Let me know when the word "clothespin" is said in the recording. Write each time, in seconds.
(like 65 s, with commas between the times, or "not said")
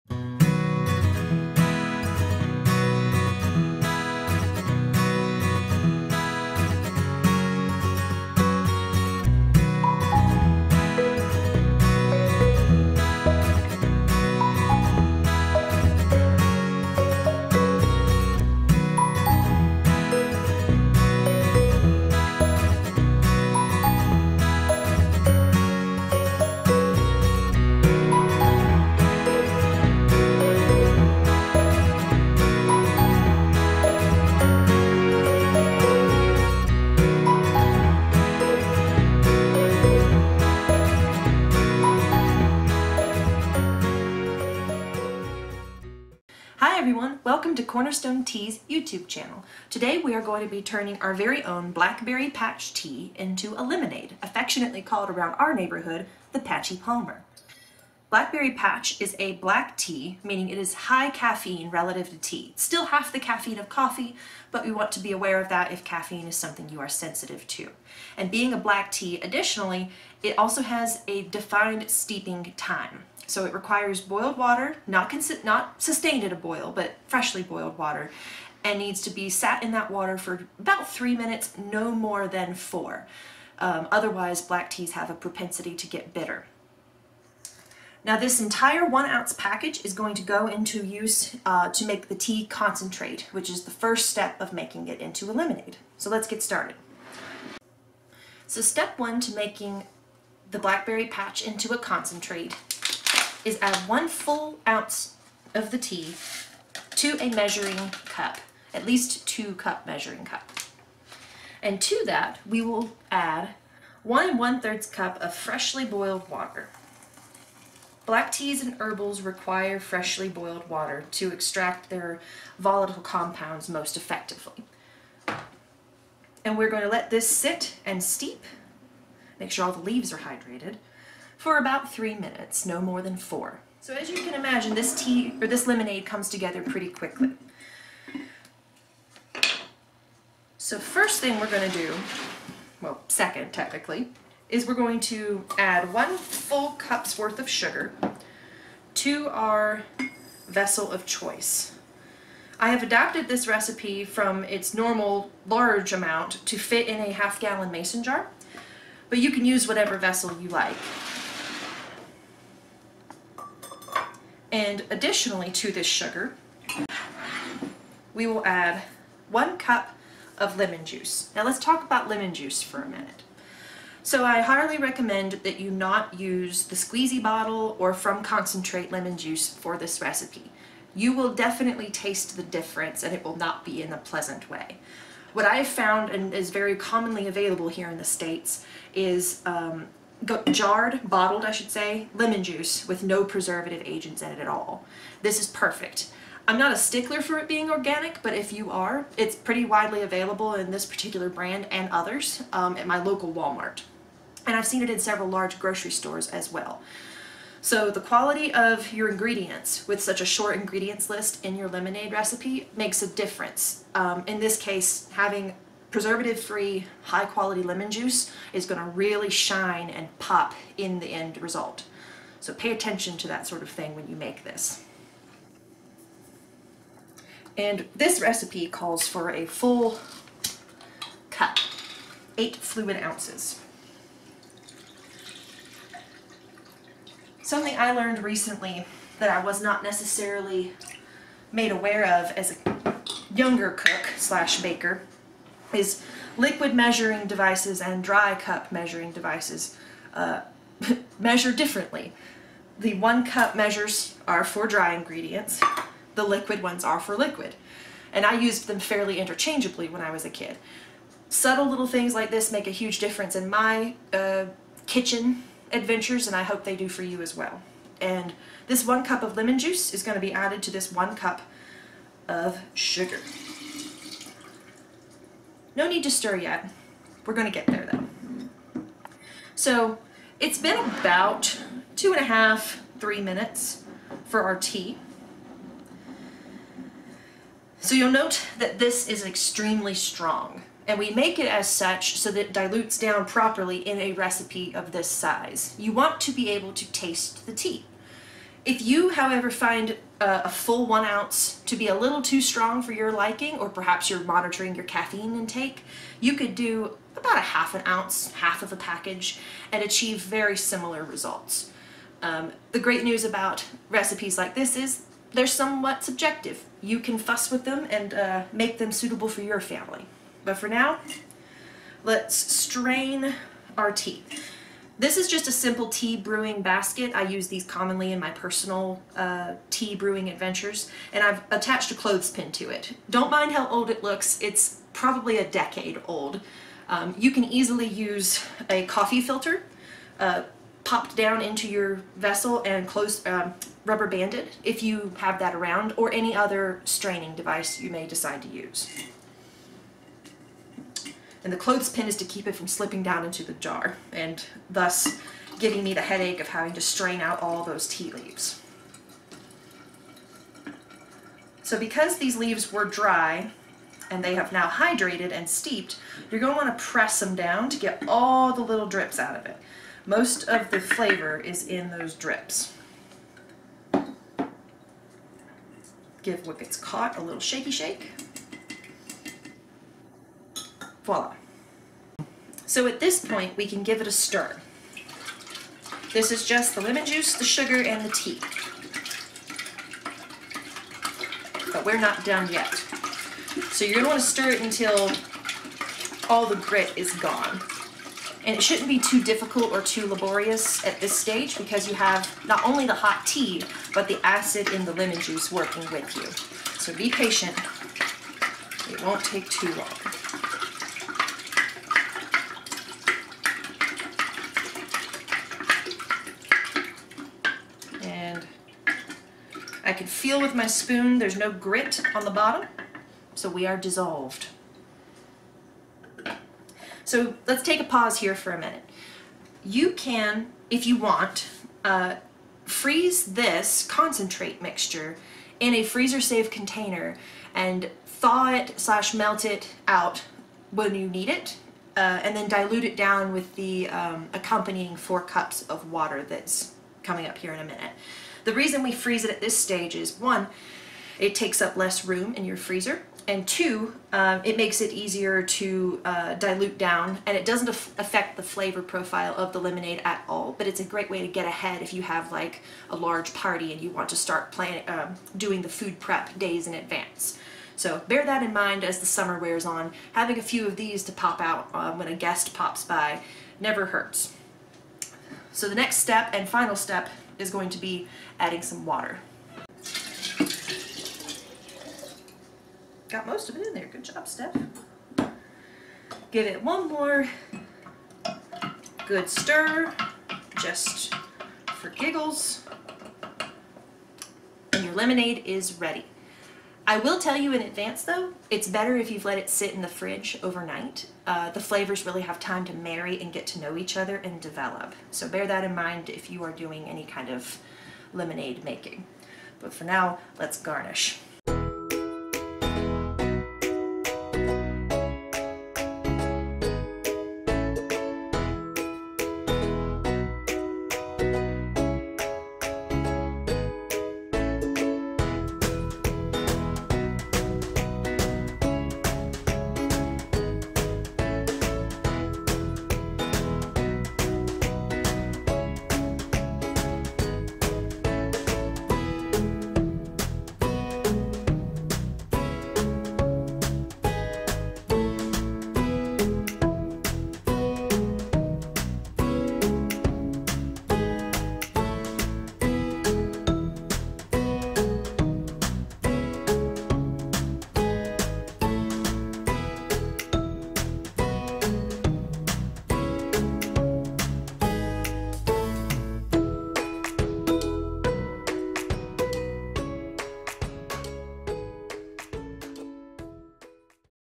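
331 s, 351 s.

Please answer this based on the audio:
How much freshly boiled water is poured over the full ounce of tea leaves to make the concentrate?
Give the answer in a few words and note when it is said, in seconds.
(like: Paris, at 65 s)
1 1/3 cups, at 114 s.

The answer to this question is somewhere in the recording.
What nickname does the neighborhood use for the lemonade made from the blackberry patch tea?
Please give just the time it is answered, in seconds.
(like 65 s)
56 s.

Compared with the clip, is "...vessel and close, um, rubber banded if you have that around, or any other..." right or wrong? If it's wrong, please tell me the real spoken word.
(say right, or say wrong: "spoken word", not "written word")
right.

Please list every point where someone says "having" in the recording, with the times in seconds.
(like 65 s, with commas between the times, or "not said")
215 s, 356 s, 470 s.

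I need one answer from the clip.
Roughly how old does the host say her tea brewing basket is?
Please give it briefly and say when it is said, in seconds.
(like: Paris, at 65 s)
A decade, at 335 s.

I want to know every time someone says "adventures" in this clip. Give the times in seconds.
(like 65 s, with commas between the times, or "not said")
265 s, 330 s.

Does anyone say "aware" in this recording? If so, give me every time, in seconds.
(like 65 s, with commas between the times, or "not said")
65 s, 241 s.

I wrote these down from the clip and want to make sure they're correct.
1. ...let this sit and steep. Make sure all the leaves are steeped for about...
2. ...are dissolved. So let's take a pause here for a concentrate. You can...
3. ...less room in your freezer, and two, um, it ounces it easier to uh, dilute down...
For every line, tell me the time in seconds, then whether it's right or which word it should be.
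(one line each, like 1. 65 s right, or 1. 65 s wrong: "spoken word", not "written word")
1. 126 s wrong: "hydrated", not "steeped"
2. 423 s wrong: "minute", not "concentrate"
3. 451 s wrong: "makes", not "ounces".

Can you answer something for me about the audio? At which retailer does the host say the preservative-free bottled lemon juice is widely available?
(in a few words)
Walmart.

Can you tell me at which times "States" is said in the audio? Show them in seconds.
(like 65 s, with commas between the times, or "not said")
188 s.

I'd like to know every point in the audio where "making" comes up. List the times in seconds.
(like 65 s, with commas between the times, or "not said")
94 s, 99 s, 508 s.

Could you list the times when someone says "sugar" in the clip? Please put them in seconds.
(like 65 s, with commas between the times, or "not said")
147 s, 165 s, 272 s, 387 s.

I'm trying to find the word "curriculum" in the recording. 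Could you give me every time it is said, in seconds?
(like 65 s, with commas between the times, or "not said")
not said.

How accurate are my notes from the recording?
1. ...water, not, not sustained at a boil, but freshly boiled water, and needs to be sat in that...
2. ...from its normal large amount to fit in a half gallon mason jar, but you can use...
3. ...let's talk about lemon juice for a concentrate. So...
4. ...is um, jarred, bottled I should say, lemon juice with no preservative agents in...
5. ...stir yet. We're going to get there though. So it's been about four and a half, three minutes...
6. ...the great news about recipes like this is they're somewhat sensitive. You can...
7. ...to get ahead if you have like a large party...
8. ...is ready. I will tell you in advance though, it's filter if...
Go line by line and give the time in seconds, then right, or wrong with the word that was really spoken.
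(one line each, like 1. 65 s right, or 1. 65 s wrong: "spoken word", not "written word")
1. 74 s right
2. 154 s right
3. 171 s wrong: "minute", not "concentrate"
4. 188 s right
5. 276 s wrong: "two", not "four"
6. 312 s wrong: "subjective", not "sensitive"
7. 461 s right
8. 495 s wrong: "better", not "filter".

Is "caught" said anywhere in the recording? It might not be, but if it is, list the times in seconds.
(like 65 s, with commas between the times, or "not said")
376 s.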